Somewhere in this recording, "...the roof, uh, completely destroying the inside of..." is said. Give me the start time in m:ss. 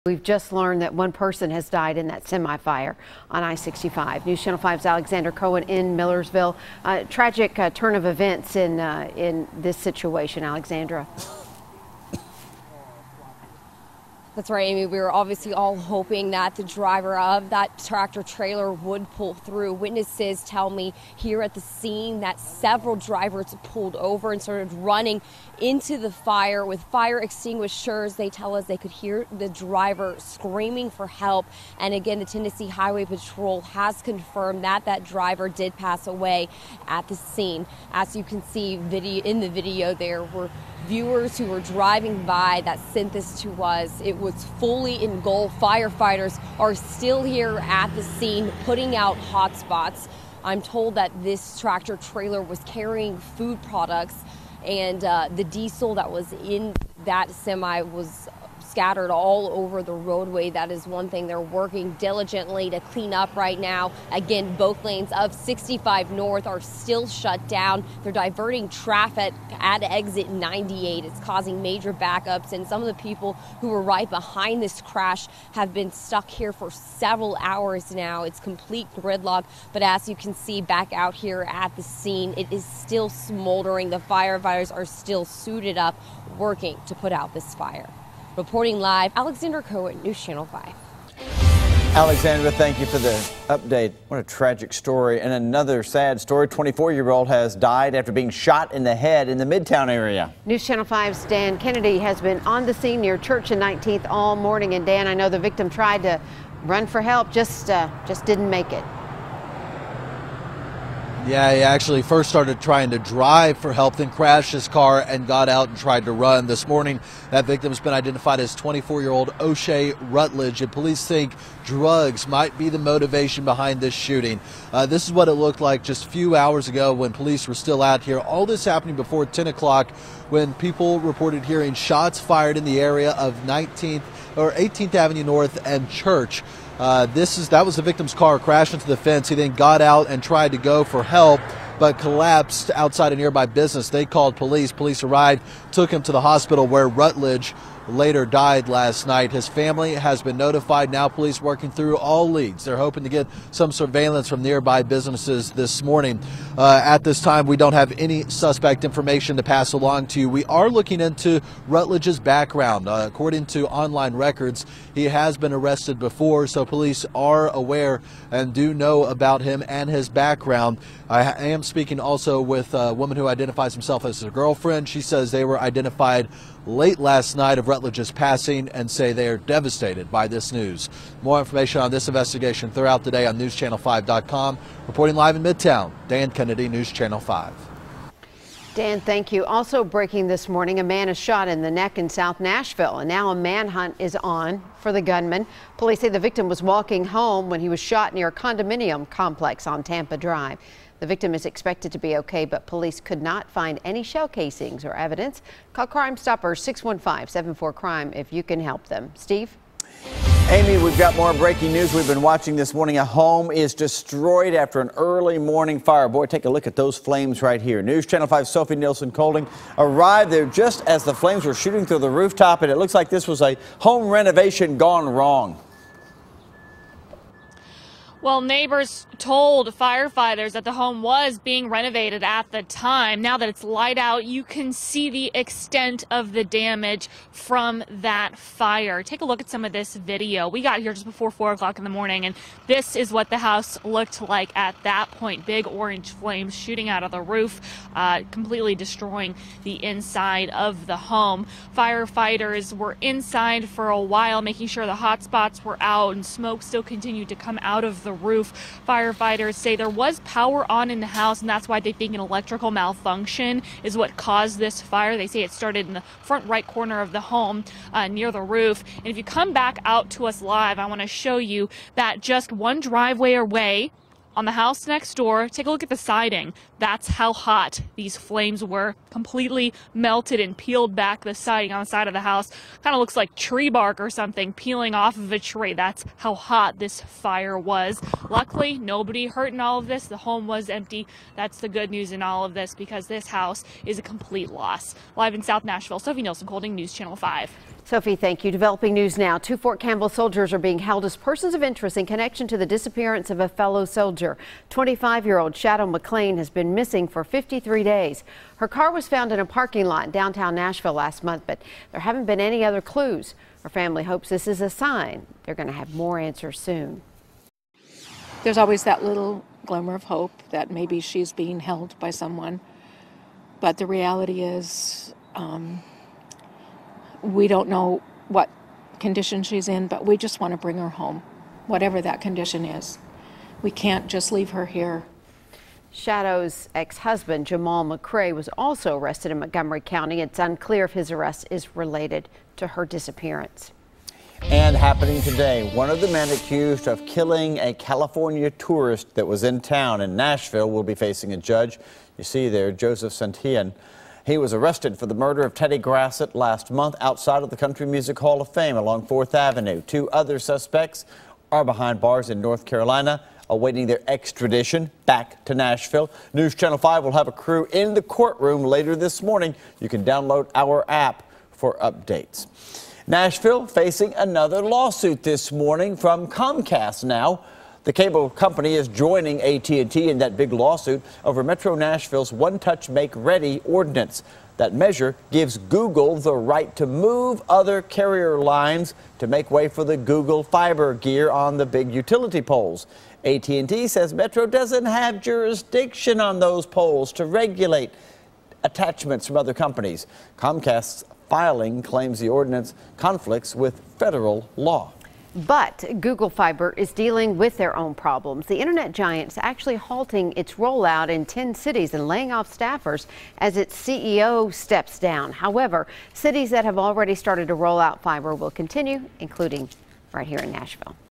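4:07.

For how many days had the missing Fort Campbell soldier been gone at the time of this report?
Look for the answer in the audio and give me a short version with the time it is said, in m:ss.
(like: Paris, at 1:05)
53, at 5:07.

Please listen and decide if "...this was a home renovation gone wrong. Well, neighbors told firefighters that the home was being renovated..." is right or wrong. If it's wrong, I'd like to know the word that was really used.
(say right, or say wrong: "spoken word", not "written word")
right.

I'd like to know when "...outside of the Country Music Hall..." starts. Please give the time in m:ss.
5:57.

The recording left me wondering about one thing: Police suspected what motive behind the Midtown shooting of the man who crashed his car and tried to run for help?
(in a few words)
Drugs.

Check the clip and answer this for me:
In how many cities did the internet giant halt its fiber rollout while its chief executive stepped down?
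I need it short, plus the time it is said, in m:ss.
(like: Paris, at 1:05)
10, at 6:51.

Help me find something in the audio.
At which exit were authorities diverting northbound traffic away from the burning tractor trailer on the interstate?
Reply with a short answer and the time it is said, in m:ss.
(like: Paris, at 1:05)
Exit 98, at 1:09.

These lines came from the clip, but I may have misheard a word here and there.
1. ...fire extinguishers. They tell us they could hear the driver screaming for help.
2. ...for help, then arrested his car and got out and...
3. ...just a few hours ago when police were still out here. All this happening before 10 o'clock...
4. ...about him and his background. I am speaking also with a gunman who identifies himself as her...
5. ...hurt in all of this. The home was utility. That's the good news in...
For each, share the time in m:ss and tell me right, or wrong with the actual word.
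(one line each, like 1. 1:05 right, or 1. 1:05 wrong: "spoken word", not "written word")
1. 0:26 right
2. 1:53 wrong: "crashed", not "arrested"
3. 2:05 right
4. 2:49 wrong: "woman", not "gunman"
5. 4:49 wrong: "empty", not "utility".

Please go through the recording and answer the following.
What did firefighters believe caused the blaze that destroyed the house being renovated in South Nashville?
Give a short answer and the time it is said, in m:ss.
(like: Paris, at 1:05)
Electrical malfunction, at 4:22.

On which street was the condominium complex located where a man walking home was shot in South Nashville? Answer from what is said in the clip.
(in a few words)
Tampa Drive.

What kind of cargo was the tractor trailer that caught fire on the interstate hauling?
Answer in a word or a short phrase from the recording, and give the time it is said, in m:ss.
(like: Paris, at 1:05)
Food products, at 0:53.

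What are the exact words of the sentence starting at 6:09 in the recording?
You can download our app for updates.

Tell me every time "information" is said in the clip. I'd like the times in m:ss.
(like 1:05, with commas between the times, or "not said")
2:38, 3:01.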